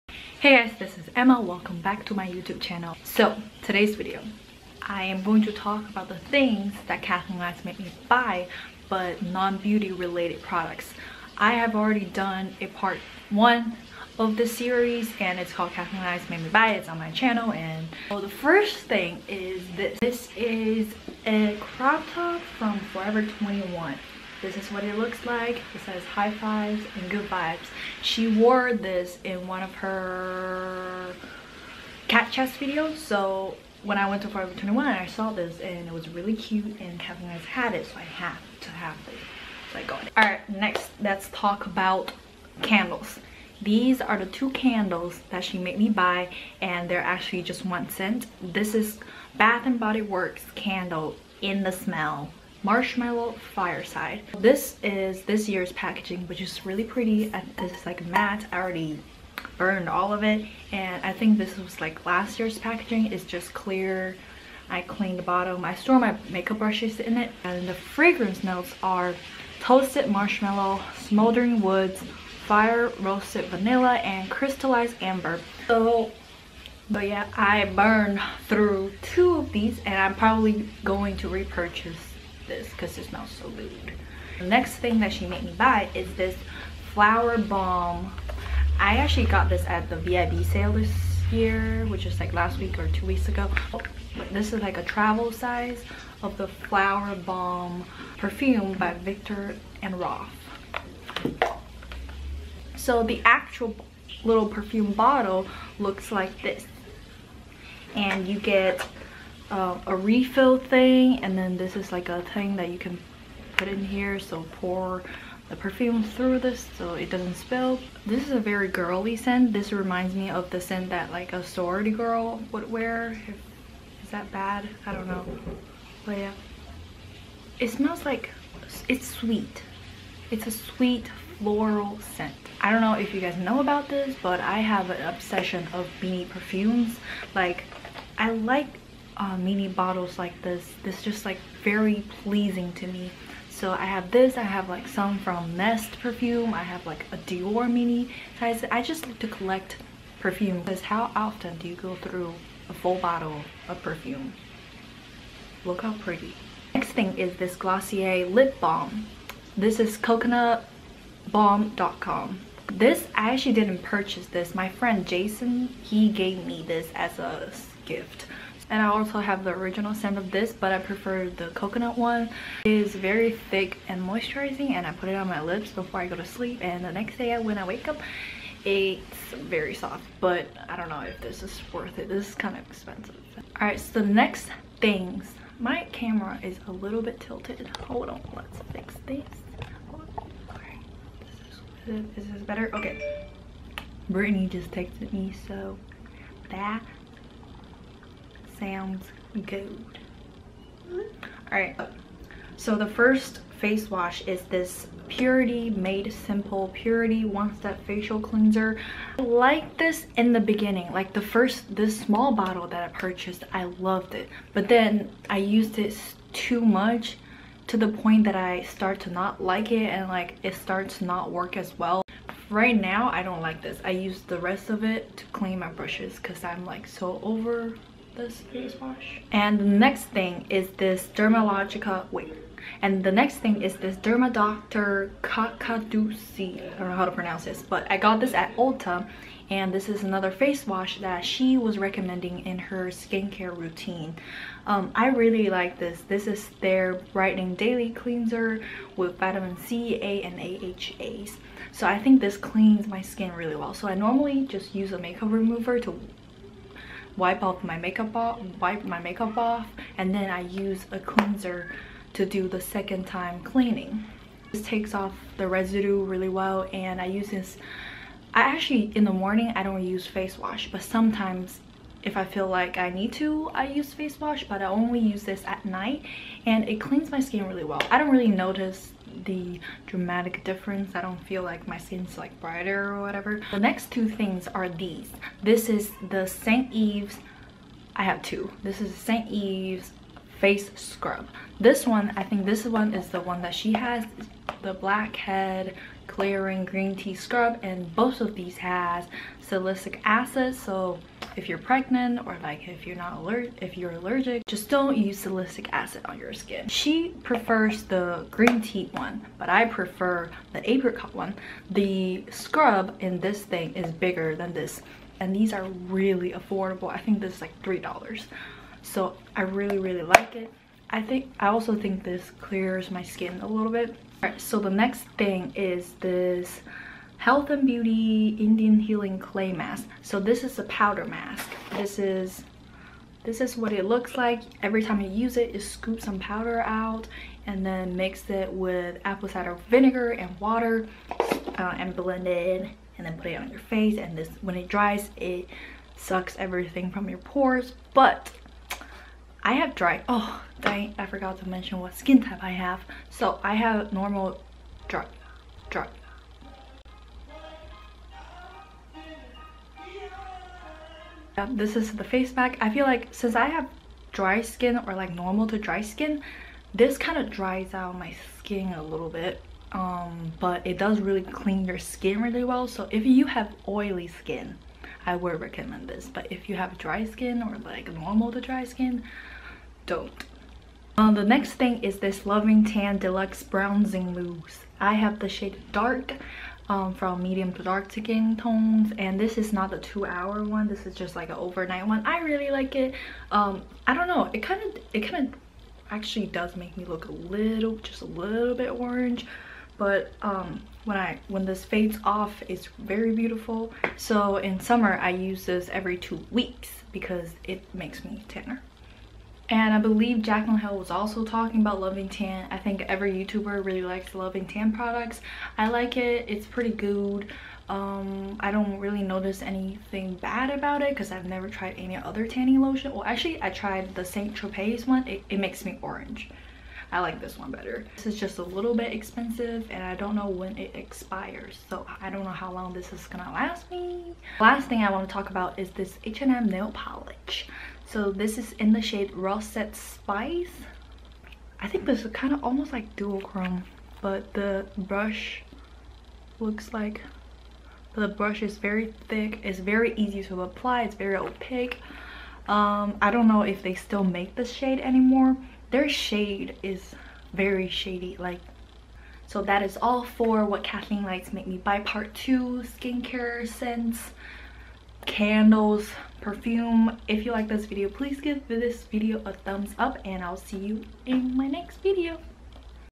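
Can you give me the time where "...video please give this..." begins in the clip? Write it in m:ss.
7:47.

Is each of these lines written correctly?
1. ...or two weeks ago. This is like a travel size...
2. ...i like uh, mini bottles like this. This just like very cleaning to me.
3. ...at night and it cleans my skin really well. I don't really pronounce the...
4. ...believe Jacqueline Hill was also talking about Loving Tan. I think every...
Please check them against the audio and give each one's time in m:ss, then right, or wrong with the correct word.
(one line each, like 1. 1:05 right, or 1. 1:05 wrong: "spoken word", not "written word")
1. 1:32 right
2. 2:18 wrong: "pleasing", not "cleaning"
3. 4:35 wrong: "notice", not "pronounce"
4. 6:49 right.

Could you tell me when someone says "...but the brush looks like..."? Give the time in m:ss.
7:24.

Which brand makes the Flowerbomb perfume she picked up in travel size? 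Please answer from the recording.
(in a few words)
Viktor and Rolf.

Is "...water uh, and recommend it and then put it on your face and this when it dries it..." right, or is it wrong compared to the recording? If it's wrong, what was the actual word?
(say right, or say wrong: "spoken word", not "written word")
wrong: "blend", not "recommend".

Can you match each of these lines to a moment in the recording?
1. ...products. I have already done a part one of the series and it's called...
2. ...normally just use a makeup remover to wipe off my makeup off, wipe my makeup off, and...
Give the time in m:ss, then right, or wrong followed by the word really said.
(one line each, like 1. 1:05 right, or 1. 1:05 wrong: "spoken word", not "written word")
1. 0:10 right
2. 4:13 right.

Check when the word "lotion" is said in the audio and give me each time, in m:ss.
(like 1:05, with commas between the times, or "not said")
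7:02.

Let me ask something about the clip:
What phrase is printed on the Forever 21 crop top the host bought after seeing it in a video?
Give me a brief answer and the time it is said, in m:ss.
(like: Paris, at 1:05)
High fives and good vibes, at 0:26.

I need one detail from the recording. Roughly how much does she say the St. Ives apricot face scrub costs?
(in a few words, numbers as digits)
3 dollars.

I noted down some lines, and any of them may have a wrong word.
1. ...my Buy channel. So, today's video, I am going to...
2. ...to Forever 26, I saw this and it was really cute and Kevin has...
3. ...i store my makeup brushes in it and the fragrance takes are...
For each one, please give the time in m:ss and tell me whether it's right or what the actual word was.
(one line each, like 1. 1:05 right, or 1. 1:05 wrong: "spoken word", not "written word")
1. 0:02 wrong: "YouTube", not "Buy"
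2. 0:34 wrong: "21", not "26"
3. 1:05 wrong: "notes", not "takes".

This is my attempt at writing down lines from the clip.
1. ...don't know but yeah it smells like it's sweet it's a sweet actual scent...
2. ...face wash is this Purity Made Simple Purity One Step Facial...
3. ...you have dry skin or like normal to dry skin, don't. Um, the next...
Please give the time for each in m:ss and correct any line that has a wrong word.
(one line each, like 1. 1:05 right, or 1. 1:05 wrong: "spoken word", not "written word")
1. 2:04 wrong: "floral", not "actual"
2. 3:23 right
3. 6:16 right.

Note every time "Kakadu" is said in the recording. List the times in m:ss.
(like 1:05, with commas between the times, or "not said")
3:55.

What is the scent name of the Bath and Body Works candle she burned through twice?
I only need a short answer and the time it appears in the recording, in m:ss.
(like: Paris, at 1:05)
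Marshmallow Fireside, at 0:52.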